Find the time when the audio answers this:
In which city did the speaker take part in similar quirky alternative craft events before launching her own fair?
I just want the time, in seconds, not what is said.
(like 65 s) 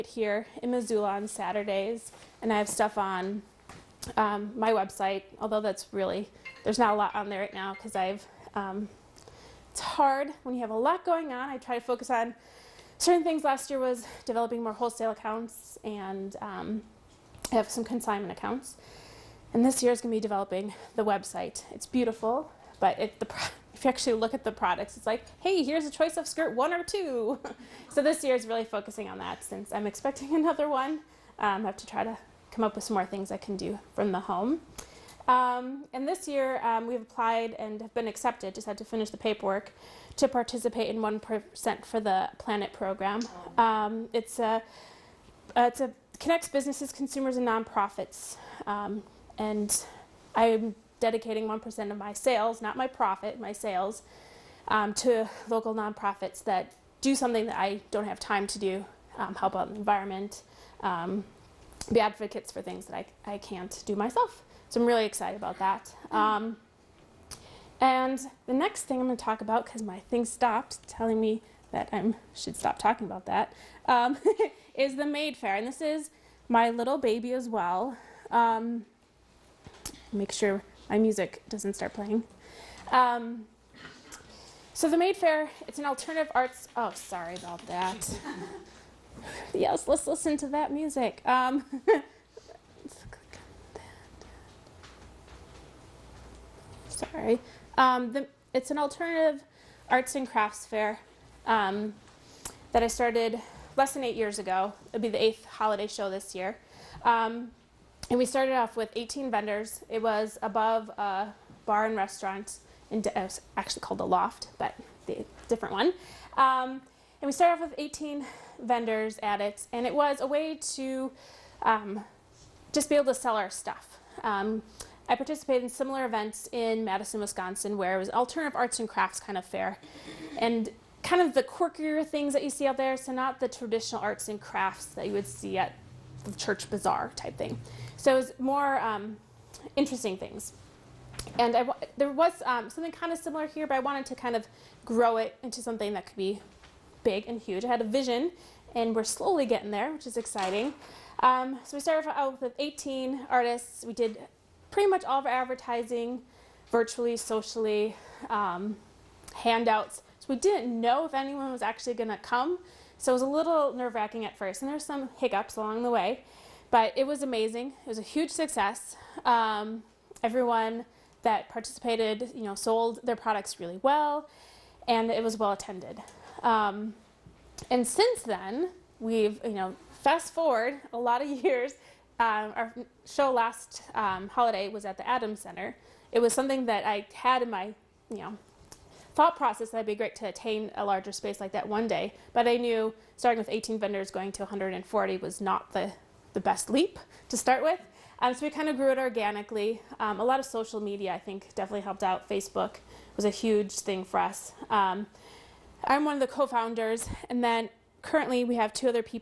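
126 s.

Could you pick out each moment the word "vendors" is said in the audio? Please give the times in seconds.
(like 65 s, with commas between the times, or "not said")
109 s, 118 s, 193 s.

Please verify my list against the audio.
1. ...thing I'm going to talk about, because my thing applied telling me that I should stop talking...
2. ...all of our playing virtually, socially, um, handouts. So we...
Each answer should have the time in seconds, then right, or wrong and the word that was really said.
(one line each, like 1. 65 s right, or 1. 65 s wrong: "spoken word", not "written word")
1. 68 s wrong: "stopped", not "applied"
2. 155 s wrong: "advertising", not "playing".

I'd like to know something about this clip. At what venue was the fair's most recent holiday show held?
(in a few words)
Adams Center.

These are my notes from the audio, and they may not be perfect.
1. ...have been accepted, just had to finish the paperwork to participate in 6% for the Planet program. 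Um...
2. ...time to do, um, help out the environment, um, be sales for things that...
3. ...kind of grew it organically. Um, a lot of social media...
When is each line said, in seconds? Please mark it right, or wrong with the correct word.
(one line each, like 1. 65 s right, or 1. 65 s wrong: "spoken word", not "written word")
1. 37 s wrong: "1", not "6"
2. 58 s wrong: "advocates", not "sales"
3. 198 s right.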